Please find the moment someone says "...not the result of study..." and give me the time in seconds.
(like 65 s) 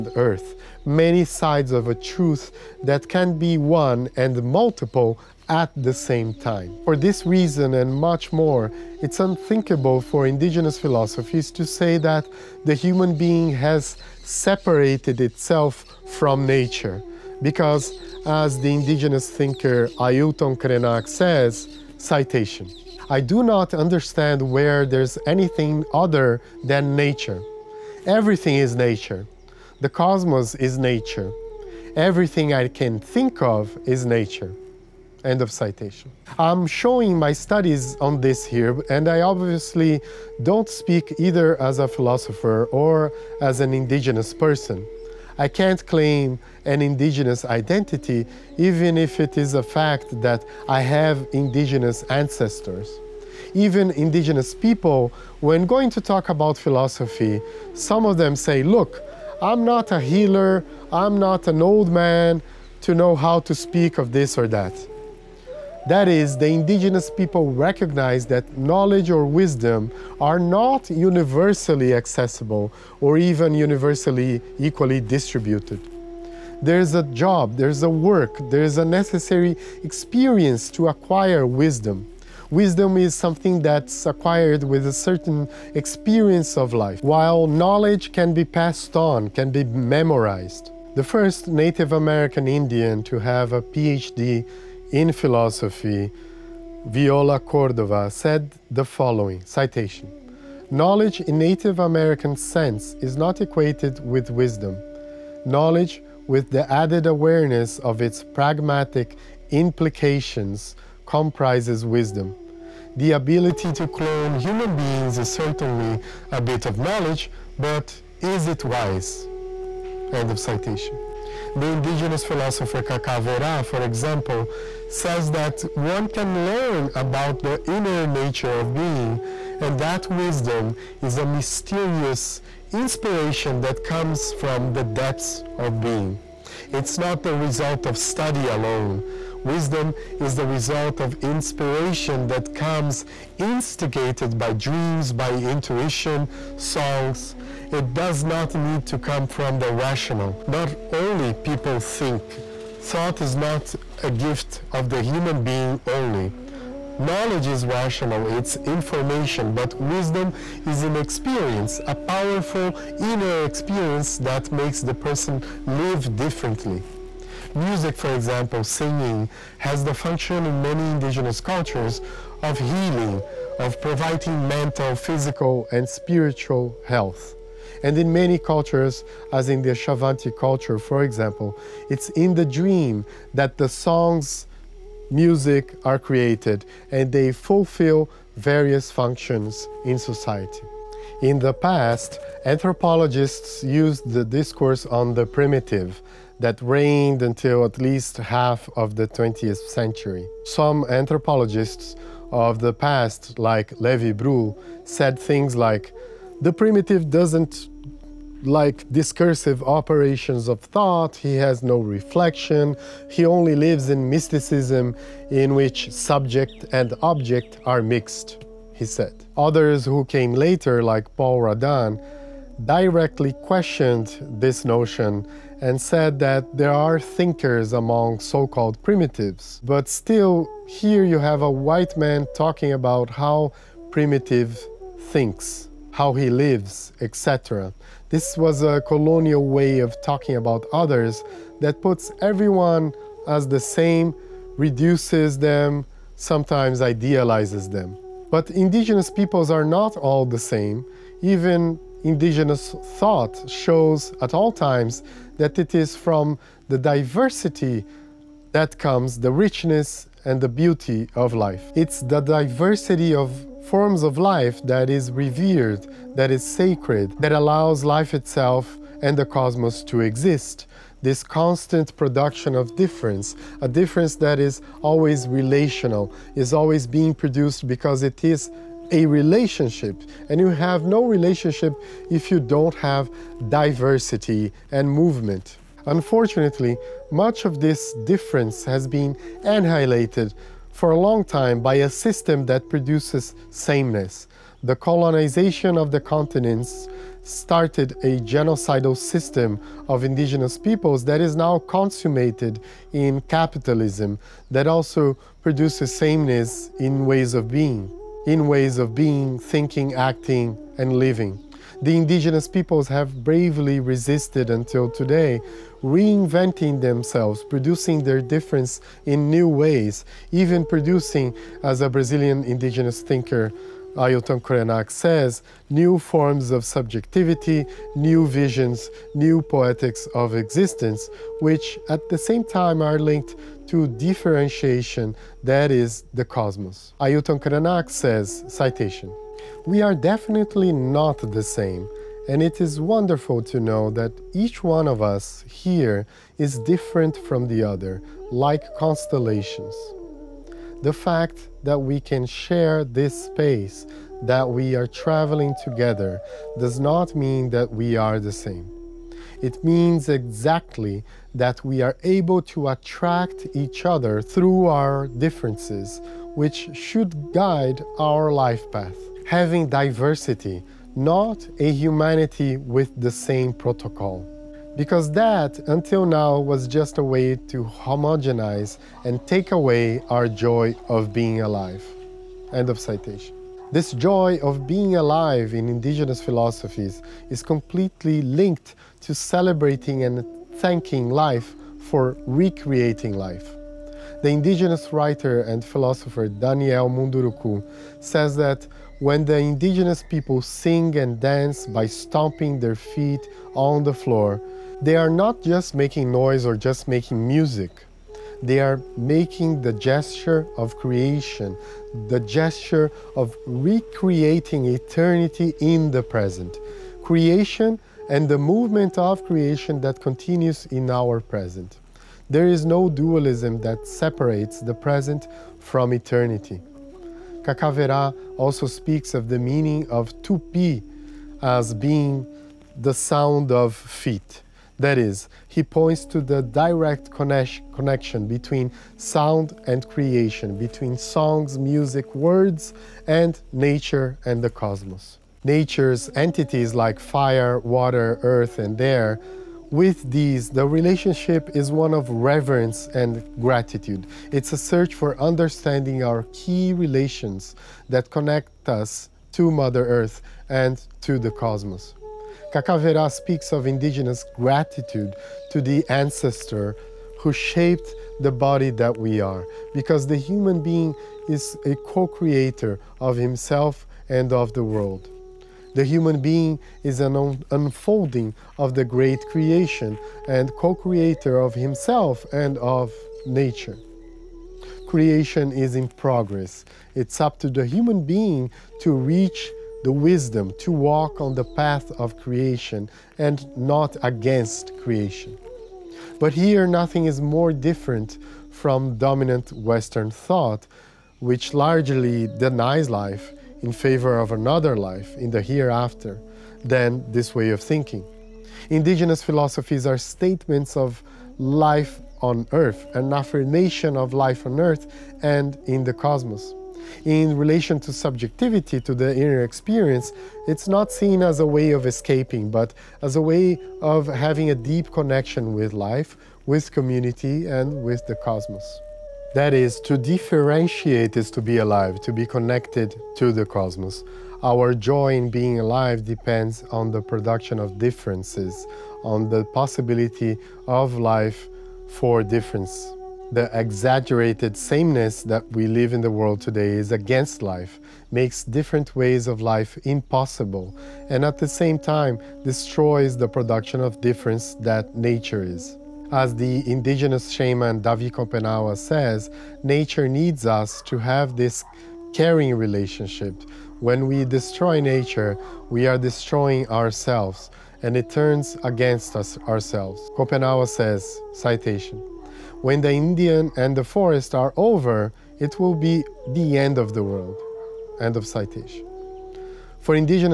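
136 s.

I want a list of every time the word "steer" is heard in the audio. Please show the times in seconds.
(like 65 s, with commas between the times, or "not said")
not said.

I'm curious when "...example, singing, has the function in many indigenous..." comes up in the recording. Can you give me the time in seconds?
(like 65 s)
168 s.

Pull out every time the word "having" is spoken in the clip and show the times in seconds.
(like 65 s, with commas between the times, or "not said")
369 s, 524 s.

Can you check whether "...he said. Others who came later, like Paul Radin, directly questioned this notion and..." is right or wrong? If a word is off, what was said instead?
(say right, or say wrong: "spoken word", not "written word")
right.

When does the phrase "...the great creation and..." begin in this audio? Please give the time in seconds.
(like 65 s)
478 s.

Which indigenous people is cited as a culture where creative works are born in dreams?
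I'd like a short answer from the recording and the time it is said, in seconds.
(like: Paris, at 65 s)
Xavante, at 179 s.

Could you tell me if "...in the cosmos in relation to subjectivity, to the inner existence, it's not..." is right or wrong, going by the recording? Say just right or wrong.
wrong.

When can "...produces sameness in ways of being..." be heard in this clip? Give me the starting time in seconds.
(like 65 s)
305 s.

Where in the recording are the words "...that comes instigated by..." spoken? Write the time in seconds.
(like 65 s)
142 s.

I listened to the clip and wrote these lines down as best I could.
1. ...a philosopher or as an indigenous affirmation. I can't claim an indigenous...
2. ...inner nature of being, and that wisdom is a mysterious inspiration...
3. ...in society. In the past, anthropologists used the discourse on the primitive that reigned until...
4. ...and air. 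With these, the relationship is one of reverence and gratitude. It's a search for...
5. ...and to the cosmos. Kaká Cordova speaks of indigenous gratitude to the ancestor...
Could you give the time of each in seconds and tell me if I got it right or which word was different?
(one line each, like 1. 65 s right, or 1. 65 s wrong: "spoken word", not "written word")
1. 41 s wrong: "person", not "affirmation"
2. 127 s right
3. 189 s right
4. 448 s right
5. 460 s wrong: "Werá", not "Cordova".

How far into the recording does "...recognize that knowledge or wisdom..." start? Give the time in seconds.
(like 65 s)
67 s.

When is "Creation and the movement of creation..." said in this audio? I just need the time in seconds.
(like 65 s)
417 s.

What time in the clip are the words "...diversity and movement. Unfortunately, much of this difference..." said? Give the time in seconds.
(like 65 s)
283 s.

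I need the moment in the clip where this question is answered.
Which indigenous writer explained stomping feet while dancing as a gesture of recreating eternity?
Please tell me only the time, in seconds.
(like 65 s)
396 s.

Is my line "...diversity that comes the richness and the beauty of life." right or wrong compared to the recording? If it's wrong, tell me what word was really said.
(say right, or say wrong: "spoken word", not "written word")
right.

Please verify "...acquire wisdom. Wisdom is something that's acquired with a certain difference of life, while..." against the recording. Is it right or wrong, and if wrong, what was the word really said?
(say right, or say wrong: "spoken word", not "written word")
wrong: "experience", not "difference".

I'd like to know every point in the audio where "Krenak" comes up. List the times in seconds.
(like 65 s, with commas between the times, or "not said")
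20 s, 324 s, 337 s.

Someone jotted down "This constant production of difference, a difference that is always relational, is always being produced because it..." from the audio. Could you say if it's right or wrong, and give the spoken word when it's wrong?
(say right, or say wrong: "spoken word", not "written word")
right.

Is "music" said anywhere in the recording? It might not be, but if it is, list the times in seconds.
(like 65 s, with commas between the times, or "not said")
167 s, 185 s, 407 s, 441 s.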